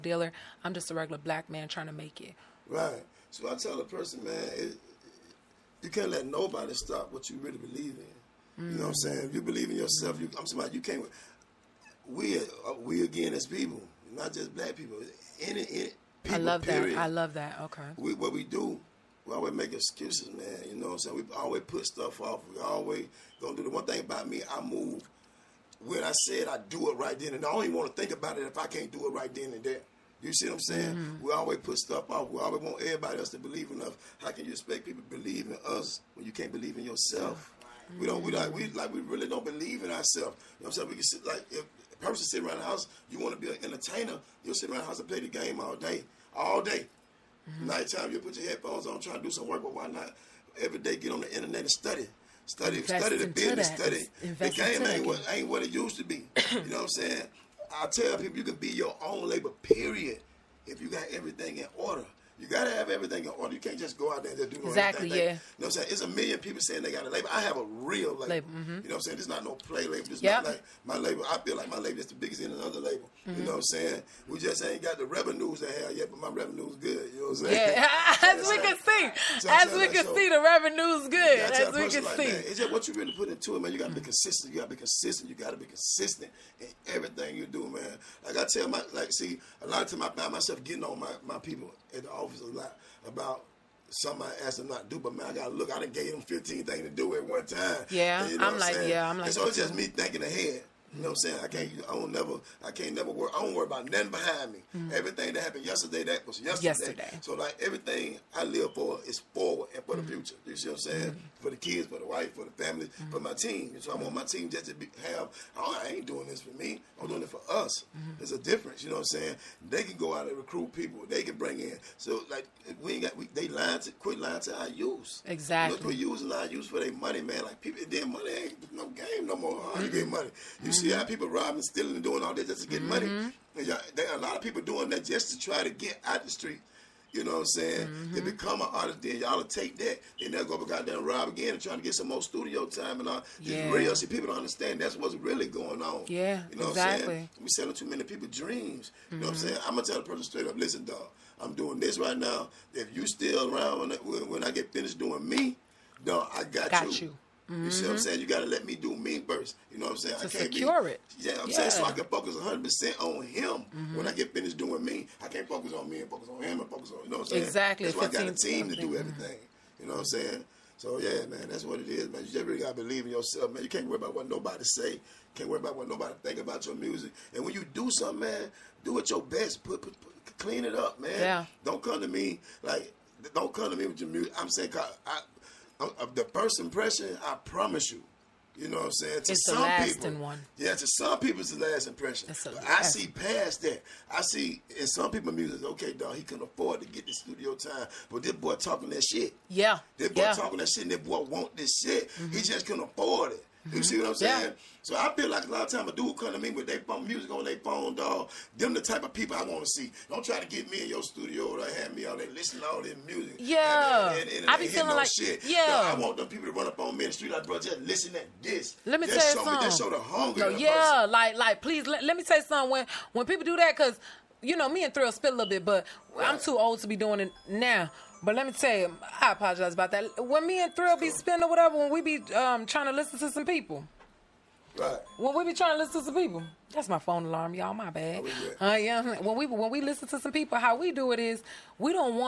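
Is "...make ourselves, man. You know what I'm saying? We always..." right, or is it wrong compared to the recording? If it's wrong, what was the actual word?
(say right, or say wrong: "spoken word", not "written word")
wrong: "excuses", not "ourselves".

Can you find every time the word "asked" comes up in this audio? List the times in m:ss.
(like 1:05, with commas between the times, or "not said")
1:34.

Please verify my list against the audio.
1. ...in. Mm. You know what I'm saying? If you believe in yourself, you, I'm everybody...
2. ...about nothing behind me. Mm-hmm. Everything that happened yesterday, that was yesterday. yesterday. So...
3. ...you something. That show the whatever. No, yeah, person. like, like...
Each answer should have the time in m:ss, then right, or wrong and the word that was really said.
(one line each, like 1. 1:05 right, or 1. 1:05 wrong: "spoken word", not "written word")
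1. 0:08 wrong: "somebody", not "everybody"
2. 1:43 right
3. 3:39 wrong: "hunger", not "whatever".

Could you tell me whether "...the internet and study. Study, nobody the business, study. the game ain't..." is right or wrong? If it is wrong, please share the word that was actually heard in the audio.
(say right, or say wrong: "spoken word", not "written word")
wrong: "study", not "nobody".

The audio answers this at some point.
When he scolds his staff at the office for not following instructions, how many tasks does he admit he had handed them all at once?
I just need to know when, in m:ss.
1:36.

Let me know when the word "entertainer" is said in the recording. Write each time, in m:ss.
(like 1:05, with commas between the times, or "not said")
0:43.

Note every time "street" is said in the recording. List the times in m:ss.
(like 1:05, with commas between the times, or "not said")
2:16, 3:37.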